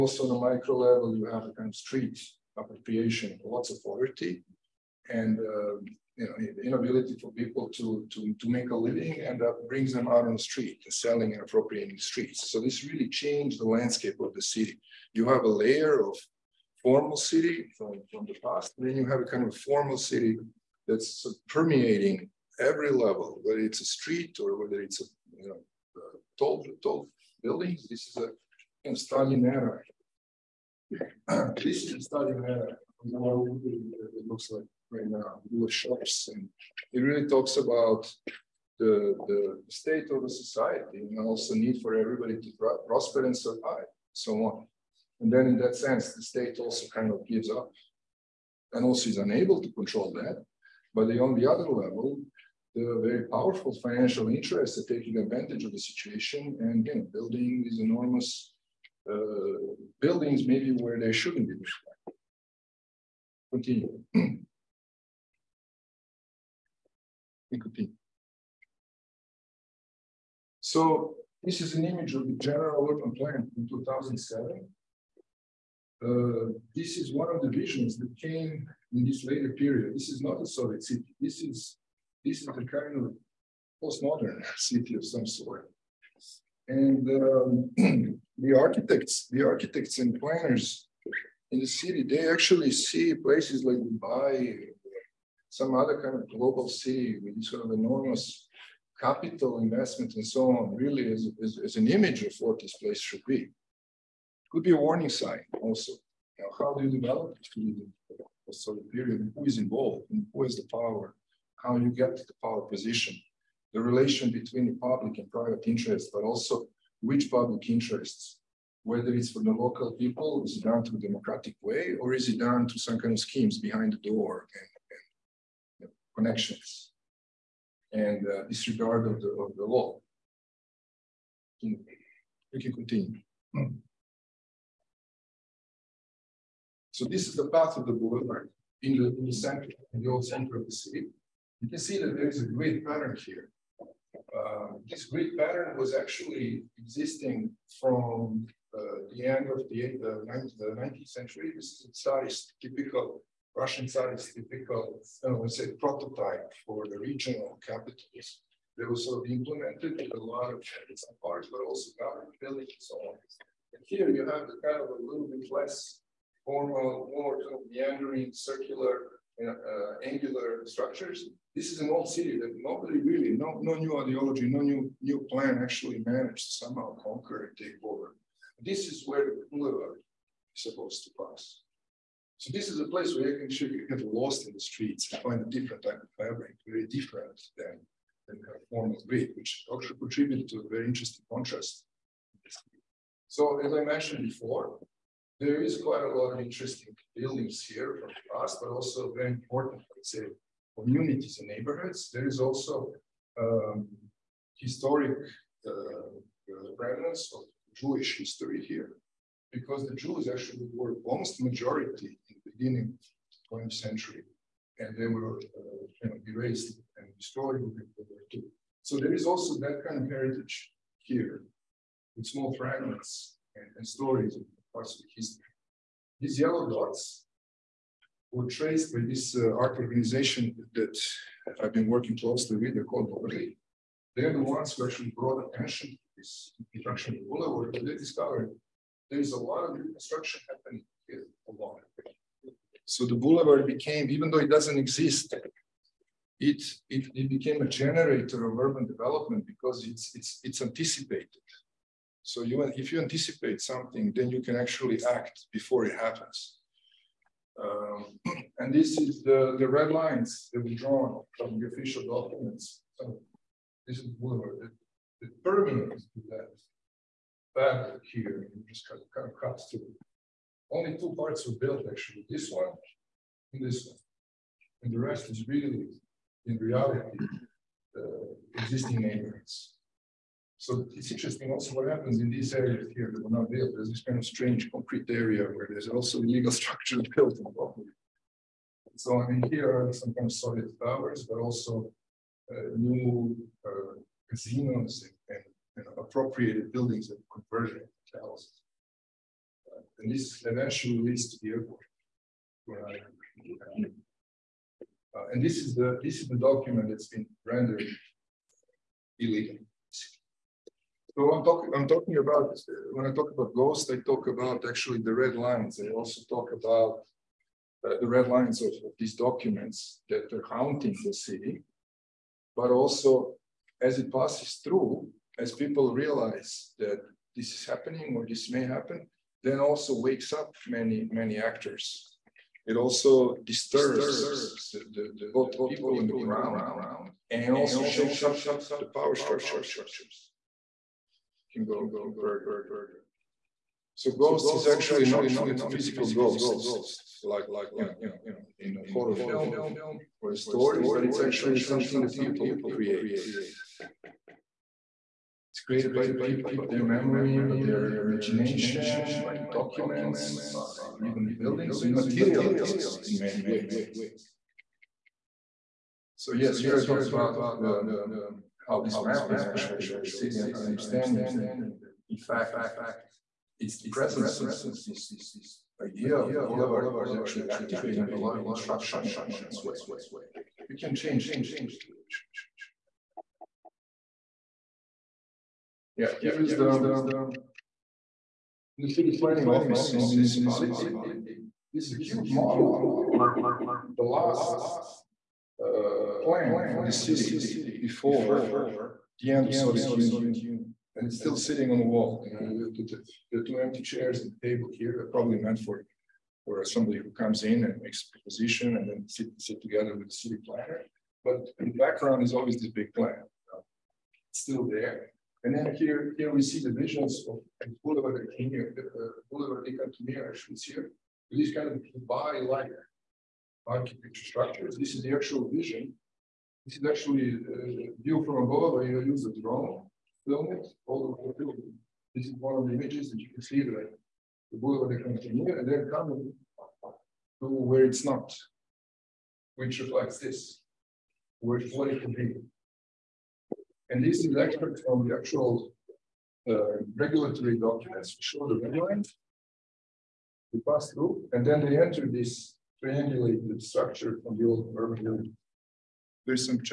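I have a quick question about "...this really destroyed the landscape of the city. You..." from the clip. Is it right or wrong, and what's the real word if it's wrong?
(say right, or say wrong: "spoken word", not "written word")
wrong: "changed", not "destroyed".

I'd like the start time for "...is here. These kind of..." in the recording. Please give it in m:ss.
7:00.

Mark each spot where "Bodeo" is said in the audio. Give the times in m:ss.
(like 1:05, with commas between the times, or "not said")
not said.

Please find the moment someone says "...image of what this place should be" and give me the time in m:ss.
1:41.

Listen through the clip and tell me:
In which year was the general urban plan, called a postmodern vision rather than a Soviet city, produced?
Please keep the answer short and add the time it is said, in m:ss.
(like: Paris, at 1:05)
2007, at 1:13.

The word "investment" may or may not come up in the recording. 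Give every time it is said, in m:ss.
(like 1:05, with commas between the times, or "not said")
1:39.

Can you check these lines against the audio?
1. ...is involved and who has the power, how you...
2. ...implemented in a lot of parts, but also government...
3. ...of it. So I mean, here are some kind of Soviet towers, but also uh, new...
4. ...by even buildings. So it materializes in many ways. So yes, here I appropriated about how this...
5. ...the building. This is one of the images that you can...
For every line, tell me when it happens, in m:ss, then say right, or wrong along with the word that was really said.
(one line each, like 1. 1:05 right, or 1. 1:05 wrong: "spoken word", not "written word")
1. 1:49 right
2. 2:39 right
3. 4:47 right
4. 6:00 wrong: "talked", not "appropriated"
5. 7:11 right.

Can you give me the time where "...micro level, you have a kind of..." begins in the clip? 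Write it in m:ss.
0:00.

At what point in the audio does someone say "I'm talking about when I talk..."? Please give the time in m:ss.
5:11.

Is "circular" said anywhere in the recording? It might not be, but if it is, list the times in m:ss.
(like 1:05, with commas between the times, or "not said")
2:48.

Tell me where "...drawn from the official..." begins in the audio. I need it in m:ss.
4:20.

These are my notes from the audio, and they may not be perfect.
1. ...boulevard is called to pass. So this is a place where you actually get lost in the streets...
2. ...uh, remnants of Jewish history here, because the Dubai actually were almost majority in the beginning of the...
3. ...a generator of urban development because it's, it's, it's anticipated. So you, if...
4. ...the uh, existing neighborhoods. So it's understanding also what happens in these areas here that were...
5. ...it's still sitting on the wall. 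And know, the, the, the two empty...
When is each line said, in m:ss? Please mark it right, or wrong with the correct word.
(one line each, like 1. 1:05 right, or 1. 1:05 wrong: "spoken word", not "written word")
1. 2:59 wrong: "supposed", not "called"
2. 3:25 wrong: "Jews", not "Dubai"
3. 4:07 right
4. 4:37 wrong: "interesting", not "understanding"
5. 6:41 right.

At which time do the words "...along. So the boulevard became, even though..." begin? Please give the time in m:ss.
4:01.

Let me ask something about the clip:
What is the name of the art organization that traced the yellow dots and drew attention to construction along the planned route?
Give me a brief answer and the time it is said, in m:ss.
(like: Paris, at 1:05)
Overlay, at 3:53.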